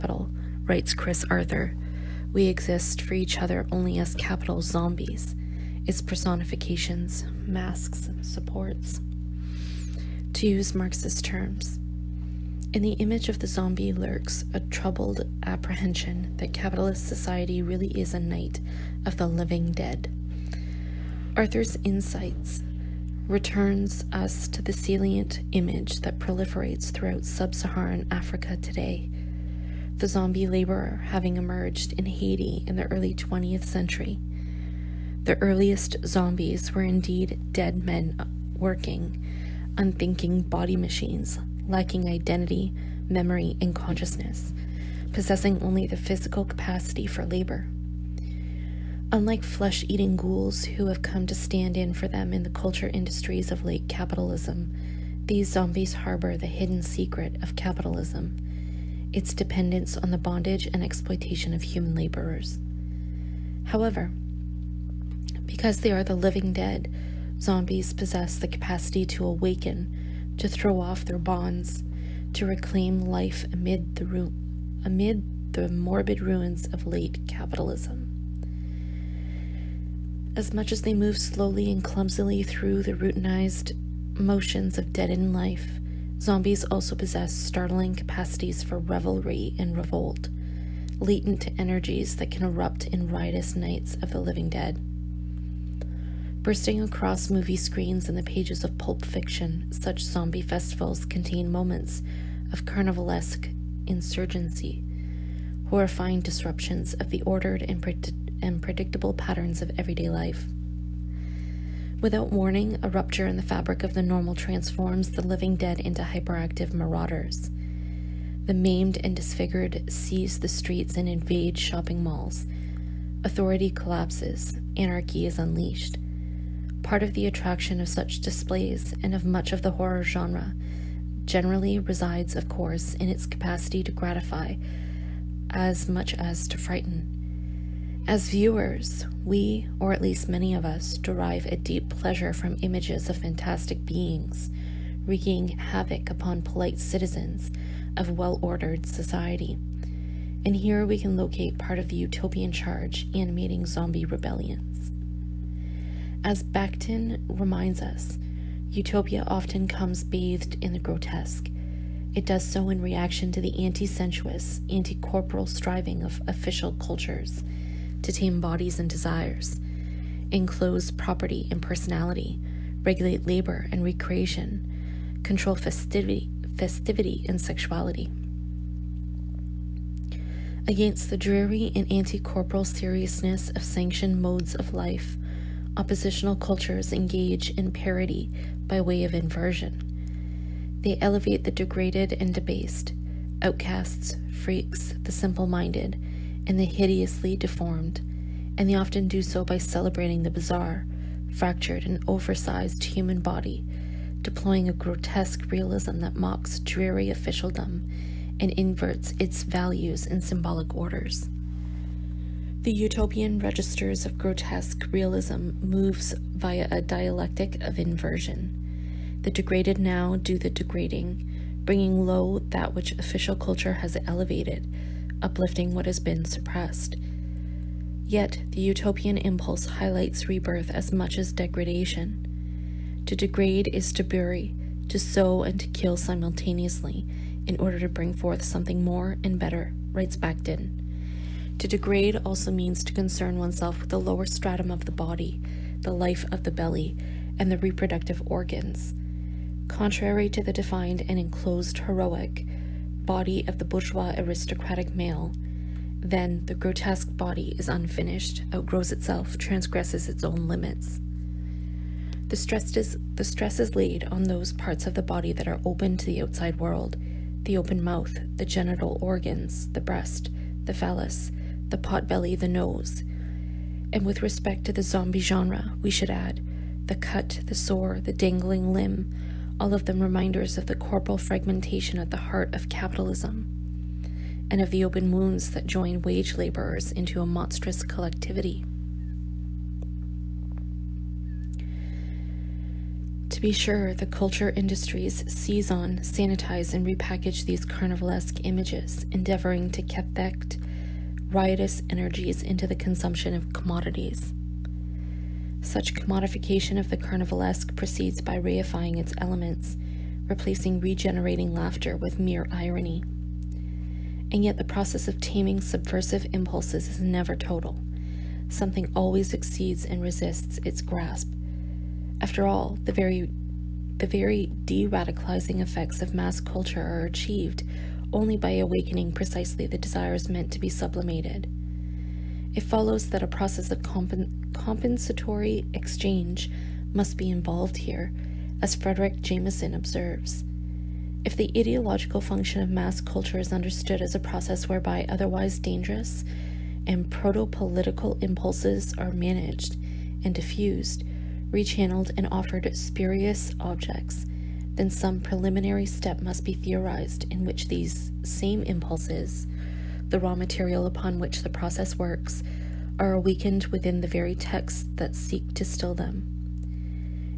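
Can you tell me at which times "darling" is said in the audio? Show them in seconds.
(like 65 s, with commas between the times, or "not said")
not said.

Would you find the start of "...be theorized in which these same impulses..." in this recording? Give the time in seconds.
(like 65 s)
356 s.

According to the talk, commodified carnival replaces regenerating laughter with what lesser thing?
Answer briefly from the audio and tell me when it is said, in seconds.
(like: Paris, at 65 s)
Irony, at 312 s.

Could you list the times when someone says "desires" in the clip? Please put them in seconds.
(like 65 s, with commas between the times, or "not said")
168 s, 329 s.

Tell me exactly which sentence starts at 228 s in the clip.
Yet, the utopian impulse highlights rebirth as much as degradation.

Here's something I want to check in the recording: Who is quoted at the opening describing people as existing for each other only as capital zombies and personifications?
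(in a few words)
Chris Arthur.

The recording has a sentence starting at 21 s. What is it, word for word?
Arthur's insights returns us to the salient image that proliferates throughout sub Saharan Africa today.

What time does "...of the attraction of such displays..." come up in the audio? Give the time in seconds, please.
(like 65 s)
127 s.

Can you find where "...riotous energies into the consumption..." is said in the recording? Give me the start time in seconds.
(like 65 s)
301 s.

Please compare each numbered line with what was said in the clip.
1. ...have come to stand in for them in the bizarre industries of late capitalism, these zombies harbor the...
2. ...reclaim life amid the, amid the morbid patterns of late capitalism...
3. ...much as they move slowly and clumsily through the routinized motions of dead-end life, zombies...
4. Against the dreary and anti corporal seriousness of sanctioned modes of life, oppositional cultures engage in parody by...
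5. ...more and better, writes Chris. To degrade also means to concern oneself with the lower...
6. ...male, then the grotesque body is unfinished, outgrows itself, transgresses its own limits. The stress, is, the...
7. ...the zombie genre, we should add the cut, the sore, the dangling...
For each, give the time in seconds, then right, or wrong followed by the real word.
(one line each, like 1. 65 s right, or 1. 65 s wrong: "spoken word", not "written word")
1. 50 s wrong: "culture", not "bizarre"
2. 72 s wrong: "ruins", not "patterns"
3. 80 s right
4. 180 s right
5. 238 s wrong: "Bakhtin", not "Chris"
6. 254 s right
7. 274 s right.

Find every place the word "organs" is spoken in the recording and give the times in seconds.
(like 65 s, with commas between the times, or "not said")
248 s, 269 s.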